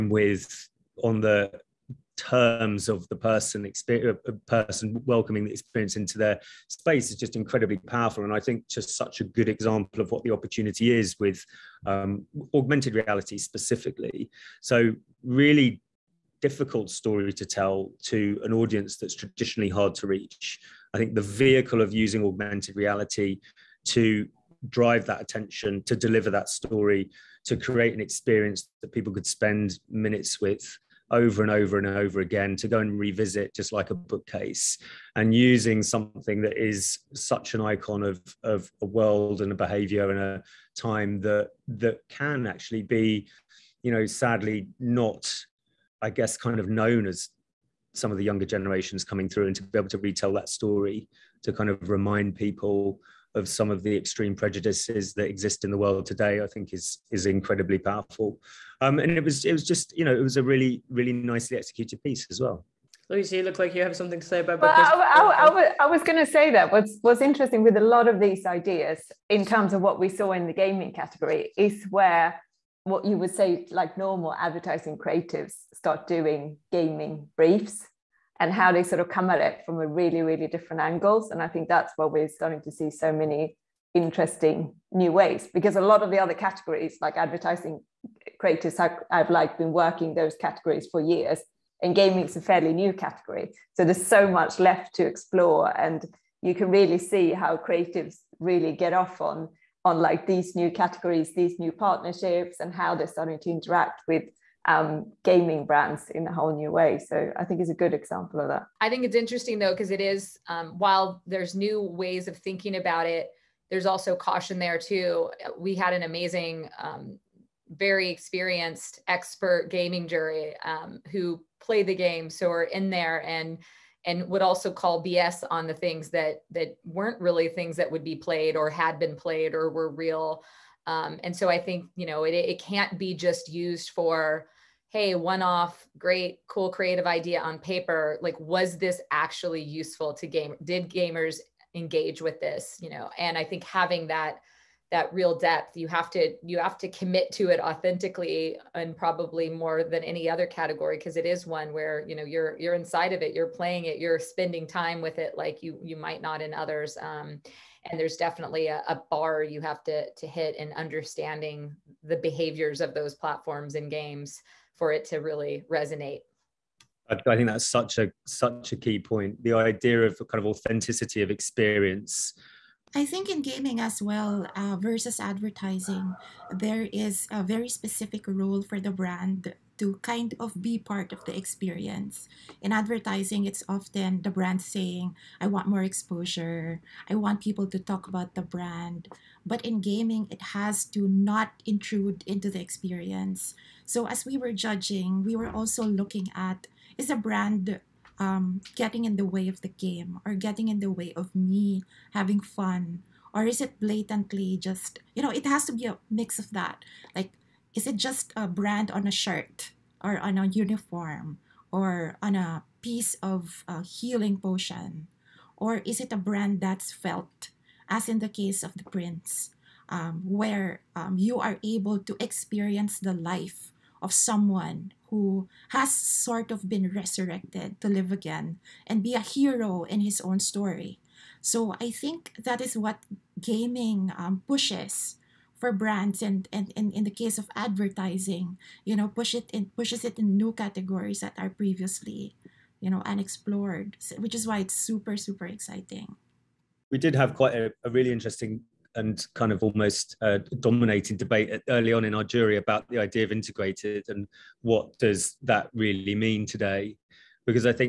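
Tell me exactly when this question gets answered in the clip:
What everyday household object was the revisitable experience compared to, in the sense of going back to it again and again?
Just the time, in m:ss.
0:33.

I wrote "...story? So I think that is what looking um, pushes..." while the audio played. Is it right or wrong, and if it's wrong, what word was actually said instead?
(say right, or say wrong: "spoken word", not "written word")
wrong: "gaming", not "looking".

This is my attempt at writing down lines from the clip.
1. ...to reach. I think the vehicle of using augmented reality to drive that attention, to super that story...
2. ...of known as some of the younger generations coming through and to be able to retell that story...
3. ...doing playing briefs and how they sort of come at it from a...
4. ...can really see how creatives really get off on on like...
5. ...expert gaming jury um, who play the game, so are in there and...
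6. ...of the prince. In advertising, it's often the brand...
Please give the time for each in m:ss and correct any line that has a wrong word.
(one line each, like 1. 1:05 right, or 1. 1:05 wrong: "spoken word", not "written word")
1. 0:19 wrong: "deliver", not "super"
2. 0:46 right
3. 1:16 wrong: "gaming", not "playing"
4. 1:36 right
5. 1:59 right
6. 3:01 wrong: "experience", not "prince".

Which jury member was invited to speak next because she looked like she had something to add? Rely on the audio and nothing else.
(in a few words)
Lucy.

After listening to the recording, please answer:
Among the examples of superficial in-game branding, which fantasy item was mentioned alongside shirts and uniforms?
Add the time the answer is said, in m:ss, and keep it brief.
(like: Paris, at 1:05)
Healing potion, at 3:33.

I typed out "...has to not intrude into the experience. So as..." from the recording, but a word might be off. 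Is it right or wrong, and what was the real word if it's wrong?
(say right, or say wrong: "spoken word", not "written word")
right.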